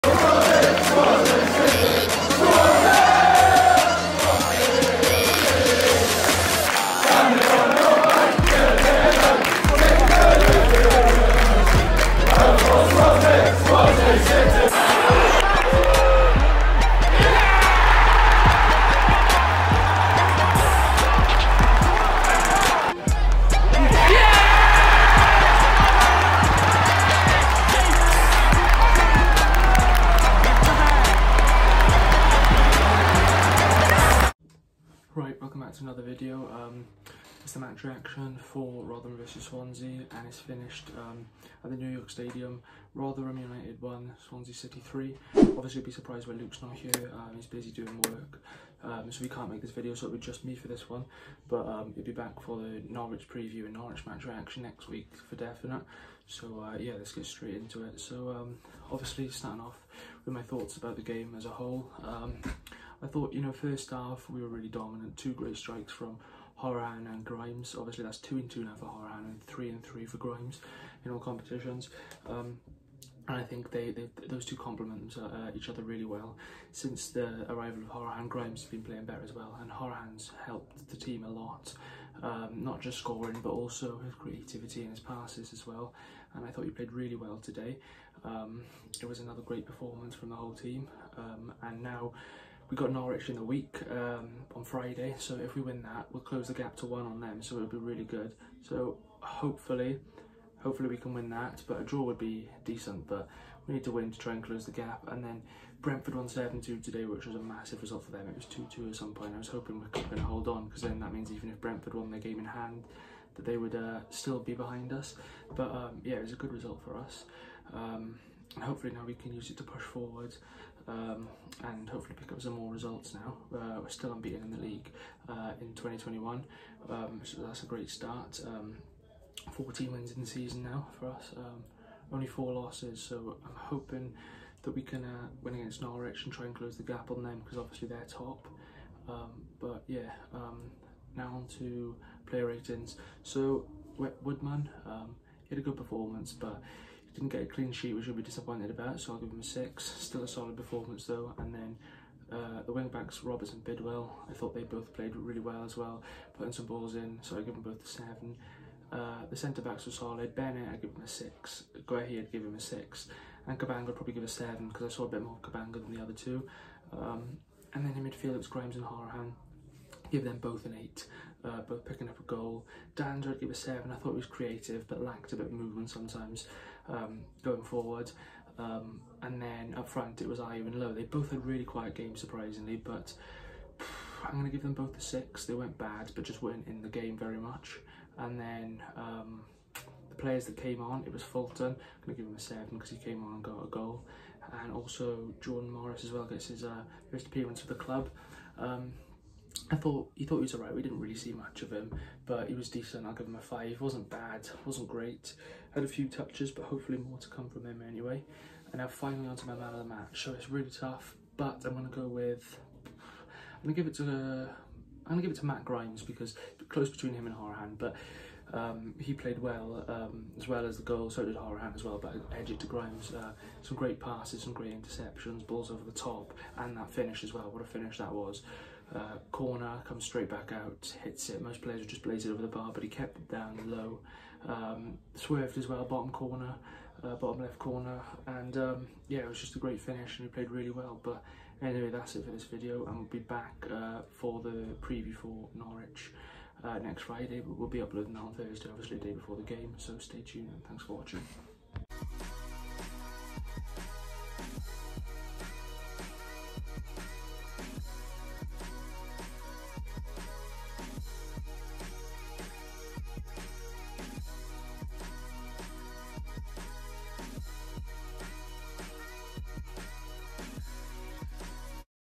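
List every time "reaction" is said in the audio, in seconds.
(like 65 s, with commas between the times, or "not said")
37 s, 54 s.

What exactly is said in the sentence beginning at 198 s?
Um, I thought he thought he was alright.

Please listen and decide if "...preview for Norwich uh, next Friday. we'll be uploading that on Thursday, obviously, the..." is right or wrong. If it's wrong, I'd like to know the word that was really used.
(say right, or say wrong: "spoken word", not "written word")
right.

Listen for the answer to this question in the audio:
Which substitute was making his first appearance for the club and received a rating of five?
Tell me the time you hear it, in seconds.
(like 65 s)
195 s.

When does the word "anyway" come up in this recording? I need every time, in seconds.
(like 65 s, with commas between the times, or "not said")
207 s, 241 s.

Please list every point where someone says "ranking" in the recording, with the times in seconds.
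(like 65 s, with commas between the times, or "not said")
not said.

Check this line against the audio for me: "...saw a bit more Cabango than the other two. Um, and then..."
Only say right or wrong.
right.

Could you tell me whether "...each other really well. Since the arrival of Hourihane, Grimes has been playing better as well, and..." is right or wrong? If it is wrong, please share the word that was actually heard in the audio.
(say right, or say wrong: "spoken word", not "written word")
right.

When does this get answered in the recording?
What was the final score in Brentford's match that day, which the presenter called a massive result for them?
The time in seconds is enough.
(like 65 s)
106 s.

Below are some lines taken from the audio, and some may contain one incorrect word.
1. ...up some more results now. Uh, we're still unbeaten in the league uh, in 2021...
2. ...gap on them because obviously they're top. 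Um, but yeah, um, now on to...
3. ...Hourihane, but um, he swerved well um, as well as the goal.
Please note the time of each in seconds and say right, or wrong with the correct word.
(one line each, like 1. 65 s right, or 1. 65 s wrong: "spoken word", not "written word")
1. 122 s right
2. 136 s right
3. 217 s wrong: "played", not "swerved".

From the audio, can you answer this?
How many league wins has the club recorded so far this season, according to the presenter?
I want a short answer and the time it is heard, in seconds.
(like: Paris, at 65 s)
14, at 129 s.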